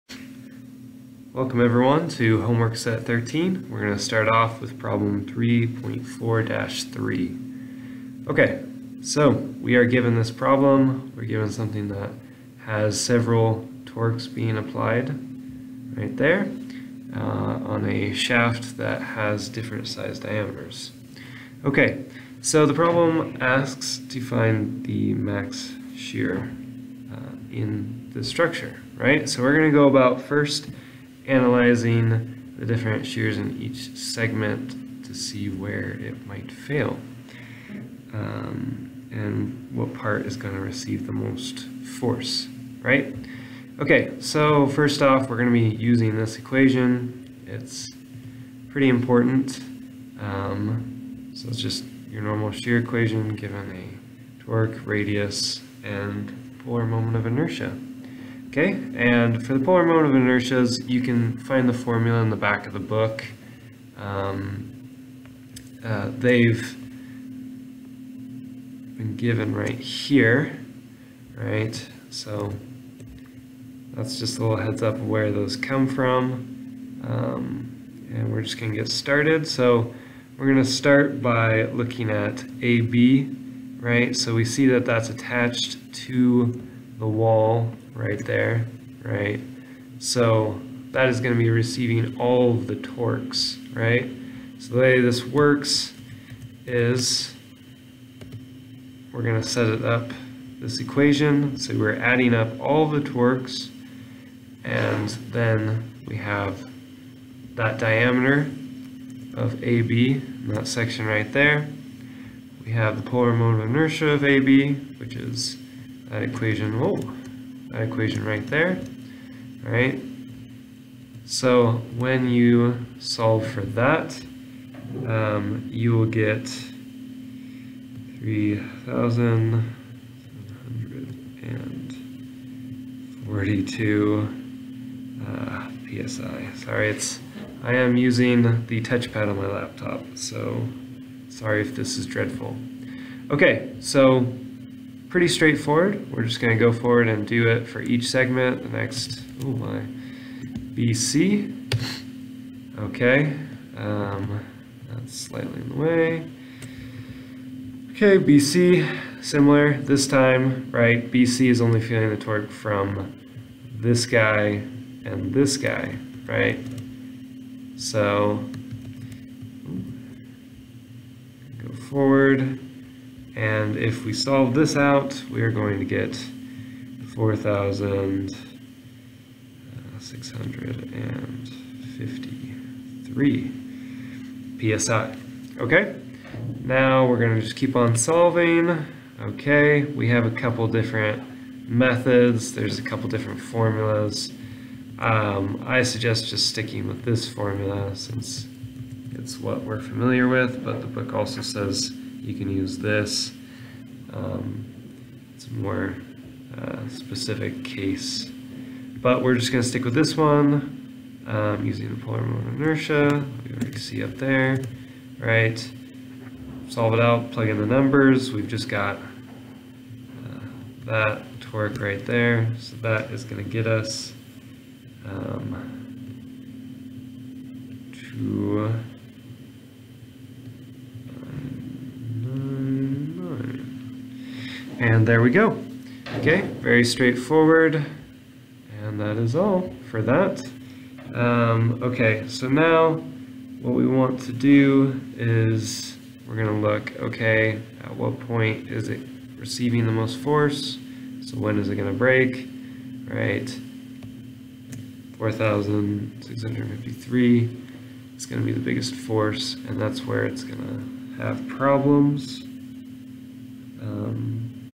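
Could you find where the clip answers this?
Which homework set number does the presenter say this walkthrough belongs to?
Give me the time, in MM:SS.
00:03.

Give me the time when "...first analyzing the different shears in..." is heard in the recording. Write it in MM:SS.
00:30.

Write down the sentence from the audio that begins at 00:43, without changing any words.
Okay, so first off, we're going to be using this equation.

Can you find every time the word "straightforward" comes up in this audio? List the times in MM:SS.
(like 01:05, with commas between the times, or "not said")
02:25, 03:56.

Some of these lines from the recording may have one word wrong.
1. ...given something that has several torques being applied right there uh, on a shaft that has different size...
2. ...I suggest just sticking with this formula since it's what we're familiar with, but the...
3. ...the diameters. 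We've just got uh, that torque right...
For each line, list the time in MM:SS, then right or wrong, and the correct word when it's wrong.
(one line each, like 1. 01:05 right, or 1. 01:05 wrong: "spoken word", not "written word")
1. 00:11 right
2. 03:15 right
3. 03:37 wrong: "numbers", not "diameters".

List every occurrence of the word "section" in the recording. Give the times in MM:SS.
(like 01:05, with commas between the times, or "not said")
01:50.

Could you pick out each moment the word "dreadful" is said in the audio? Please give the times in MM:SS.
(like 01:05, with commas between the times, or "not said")
02:22.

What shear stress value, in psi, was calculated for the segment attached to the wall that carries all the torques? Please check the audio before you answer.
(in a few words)
3,742 psi.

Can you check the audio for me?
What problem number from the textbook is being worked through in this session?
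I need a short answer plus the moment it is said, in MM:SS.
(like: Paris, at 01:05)
3.4-3, at 00:05.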